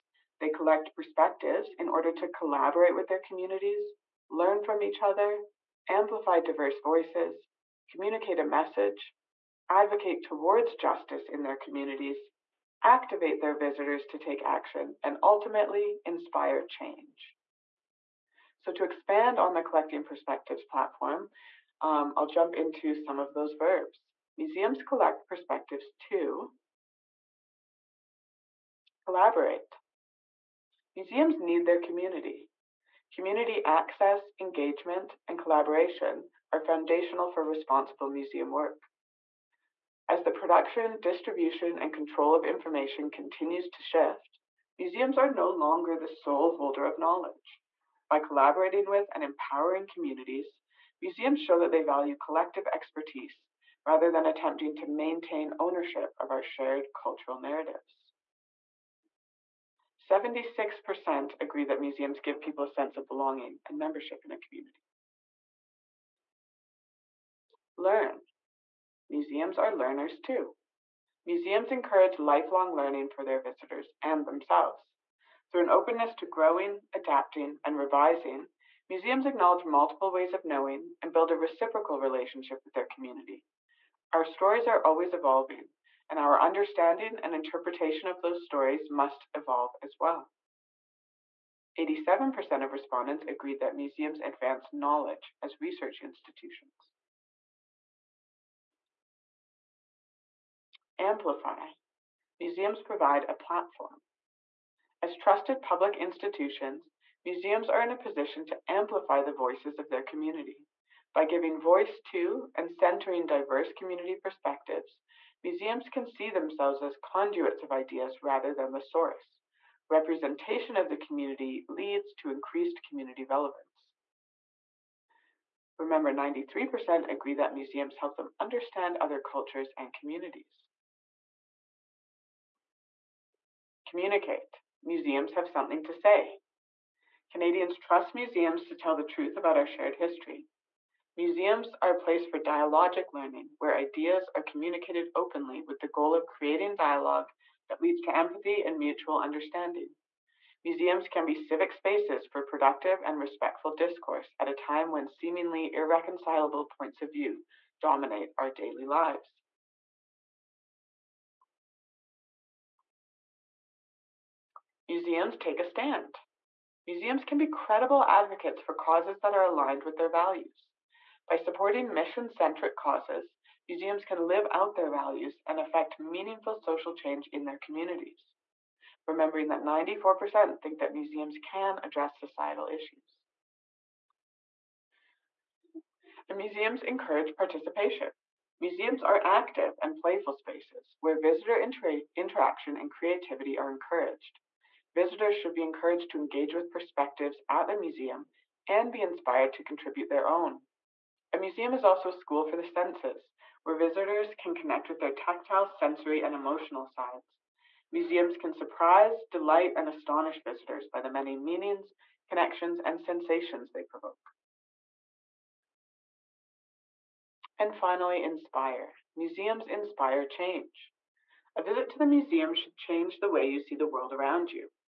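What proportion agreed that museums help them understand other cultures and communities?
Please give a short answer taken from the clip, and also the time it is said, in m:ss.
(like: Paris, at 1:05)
93%, at 2:06.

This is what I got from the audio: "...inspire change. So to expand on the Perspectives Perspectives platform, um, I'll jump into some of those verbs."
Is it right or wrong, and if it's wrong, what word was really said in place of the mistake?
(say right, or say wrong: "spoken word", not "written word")
wrong: "Collecting", not "Perspectives".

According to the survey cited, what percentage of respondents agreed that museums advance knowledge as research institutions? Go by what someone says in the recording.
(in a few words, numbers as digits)
87%.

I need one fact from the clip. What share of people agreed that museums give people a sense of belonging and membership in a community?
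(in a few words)
76%.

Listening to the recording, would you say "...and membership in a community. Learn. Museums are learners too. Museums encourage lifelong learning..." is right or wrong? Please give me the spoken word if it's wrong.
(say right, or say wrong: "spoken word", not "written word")
right.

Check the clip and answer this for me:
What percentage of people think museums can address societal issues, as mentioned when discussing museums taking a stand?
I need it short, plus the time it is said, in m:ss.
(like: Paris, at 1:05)
94%, at 2:59.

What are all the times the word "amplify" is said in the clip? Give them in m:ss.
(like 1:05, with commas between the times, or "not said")
0:05, 1:40, 1:48.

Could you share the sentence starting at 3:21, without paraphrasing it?
A museum is also a school for the senses, where visitors can connect with their tactile, sensory, and emotional sides.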